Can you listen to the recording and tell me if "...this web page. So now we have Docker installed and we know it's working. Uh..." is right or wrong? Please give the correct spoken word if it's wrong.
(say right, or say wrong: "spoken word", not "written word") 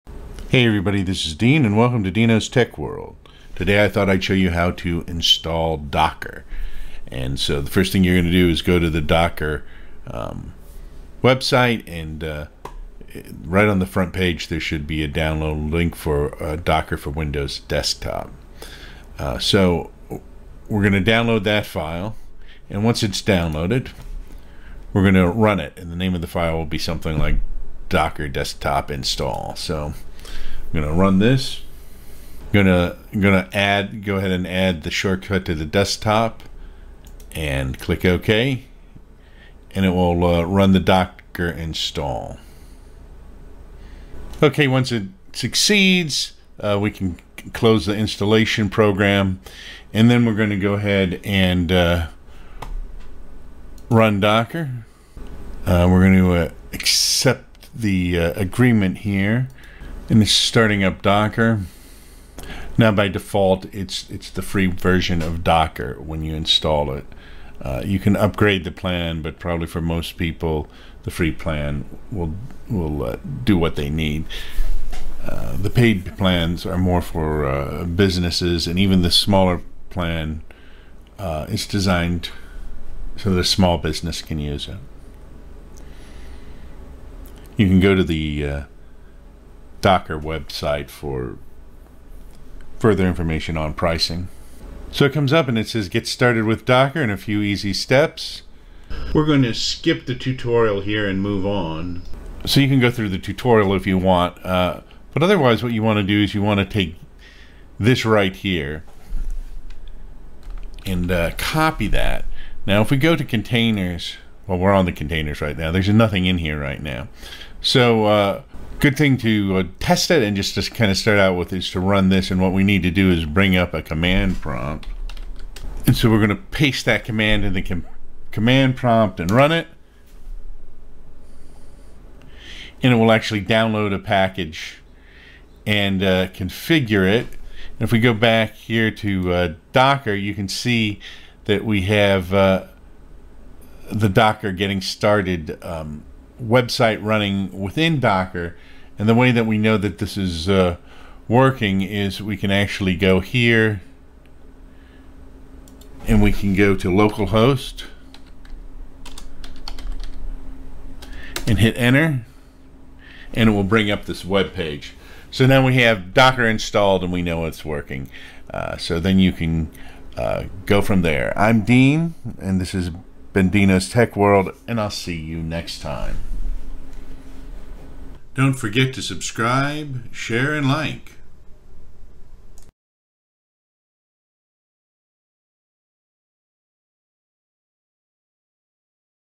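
right.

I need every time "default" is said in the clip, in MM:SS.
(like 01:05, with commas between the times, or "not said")
01:03.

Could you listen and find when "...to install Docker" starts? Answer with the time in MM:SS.
00:04.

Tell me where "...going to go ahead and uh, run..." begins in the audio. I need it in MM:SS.
00:50.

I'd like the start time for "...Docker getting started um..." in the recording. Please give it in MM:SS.
02:24.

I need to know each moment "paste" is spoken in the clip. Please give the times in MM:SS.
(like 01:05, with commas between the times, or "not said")
02:06.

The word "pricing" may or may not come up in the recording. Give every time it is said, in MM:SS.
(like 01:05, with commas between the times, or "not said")
01:33.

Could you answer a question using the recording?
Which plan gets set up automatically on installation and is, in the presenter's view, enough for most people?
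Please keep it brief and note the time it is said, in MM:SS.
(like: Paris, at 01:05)
The free version, at 01:04.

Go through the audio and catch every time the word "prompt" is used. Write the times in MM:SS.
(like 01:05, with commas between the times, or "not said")
02:04, 02:08.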